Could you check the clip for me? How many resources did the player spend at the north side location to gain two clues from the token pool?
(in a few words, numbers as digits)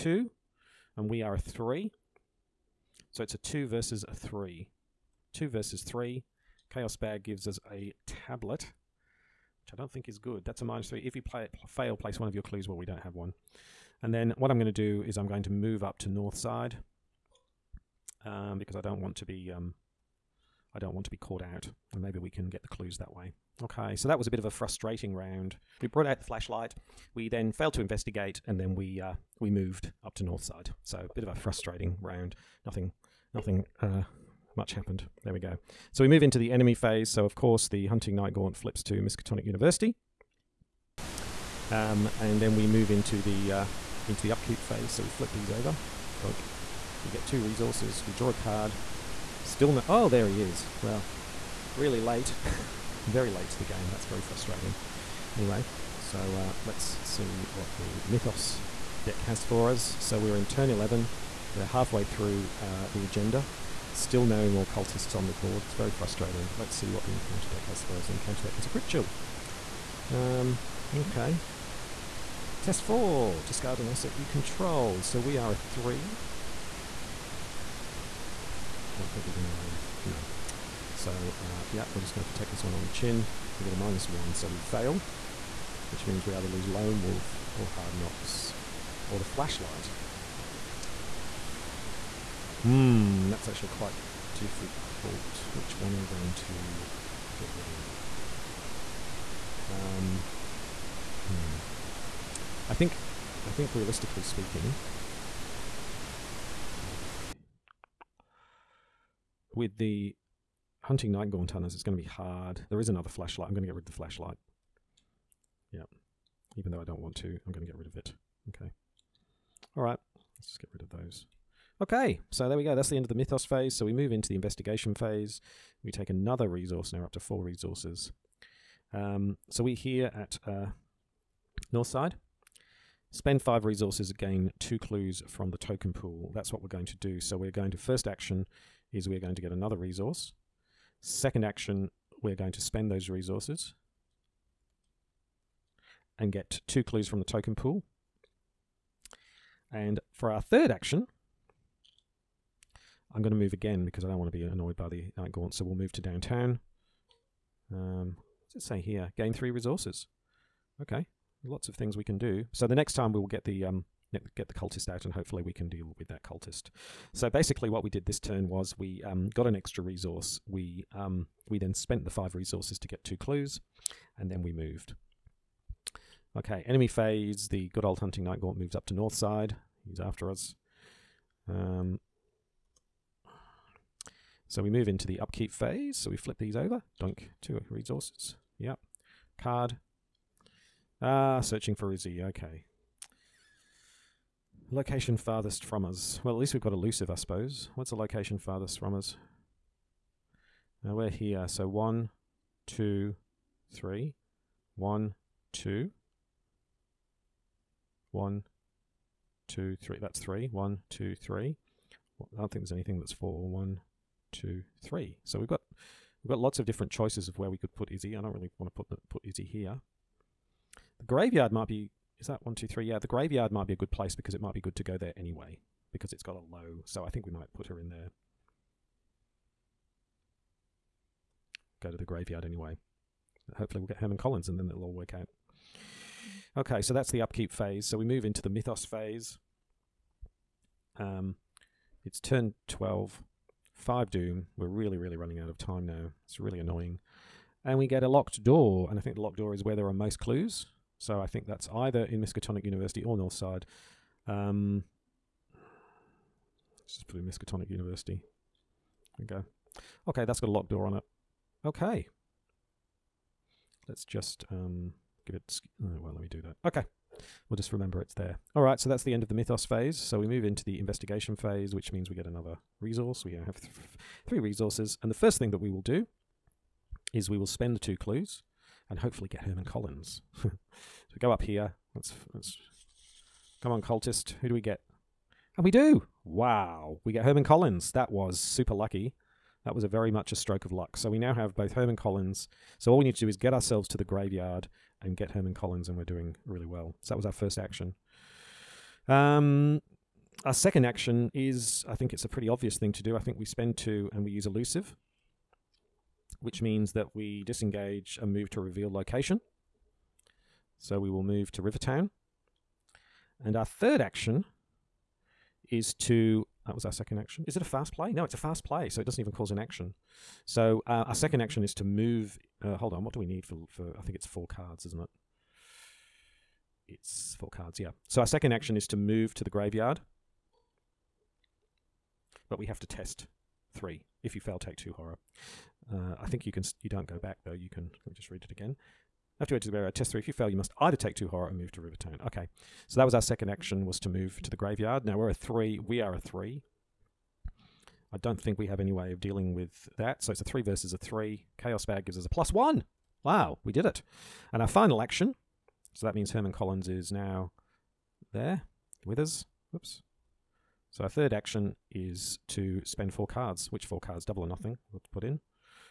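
5.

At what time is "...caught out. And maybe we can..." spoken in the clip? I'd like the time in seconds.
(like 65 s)
21 s.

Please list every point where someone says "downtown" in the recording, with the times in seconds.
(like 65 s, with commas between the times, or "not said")
156 s.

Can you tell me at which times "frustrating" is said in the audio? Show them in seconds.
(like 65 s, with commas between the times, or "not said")
24 s, 31 s, 54 s, 65 s.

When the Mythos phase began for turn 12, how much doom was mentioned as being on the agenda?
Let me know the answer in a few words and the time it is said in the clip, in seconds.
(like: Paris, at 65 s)
5, at 243 s.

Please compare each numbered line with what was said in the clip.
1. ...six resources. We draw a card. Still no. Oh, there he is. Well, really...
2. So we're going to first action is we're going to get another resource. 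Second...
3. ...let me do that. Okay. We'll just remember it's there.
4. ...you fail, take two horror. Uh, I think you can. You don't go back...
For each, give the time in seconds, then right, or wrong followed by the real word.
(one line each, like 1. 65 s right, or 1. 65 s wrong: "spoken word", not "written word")
1. 47 s wrong: "two", not "six"
2. 137 s right
3. 266 s right
4. 334 s right.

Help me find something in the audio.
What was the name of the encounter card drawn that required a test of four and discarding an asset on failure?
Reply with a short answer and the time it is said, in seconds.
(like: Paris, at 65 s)
Crypt chill, at 68 s.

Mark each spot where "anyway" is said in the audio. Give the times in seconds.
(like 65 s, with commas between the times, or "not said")
55 s, 225 s, 232 s.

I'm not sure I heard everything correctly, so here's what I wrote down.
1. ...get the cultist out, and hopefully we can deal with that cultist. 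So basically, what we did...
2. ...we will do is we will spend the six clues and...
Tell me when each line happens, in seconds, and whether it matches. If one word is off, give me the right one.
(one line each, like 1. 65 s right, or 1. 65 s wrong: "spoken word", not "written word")
1. 164 s right
2. 275 s wrong: "two", not "six".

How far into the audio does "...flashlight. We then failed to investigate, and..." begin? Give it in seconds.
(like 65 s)
26 s.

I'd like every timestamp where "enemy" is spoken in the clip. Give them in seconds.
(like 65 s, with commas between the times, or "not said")
36 s, 176 s.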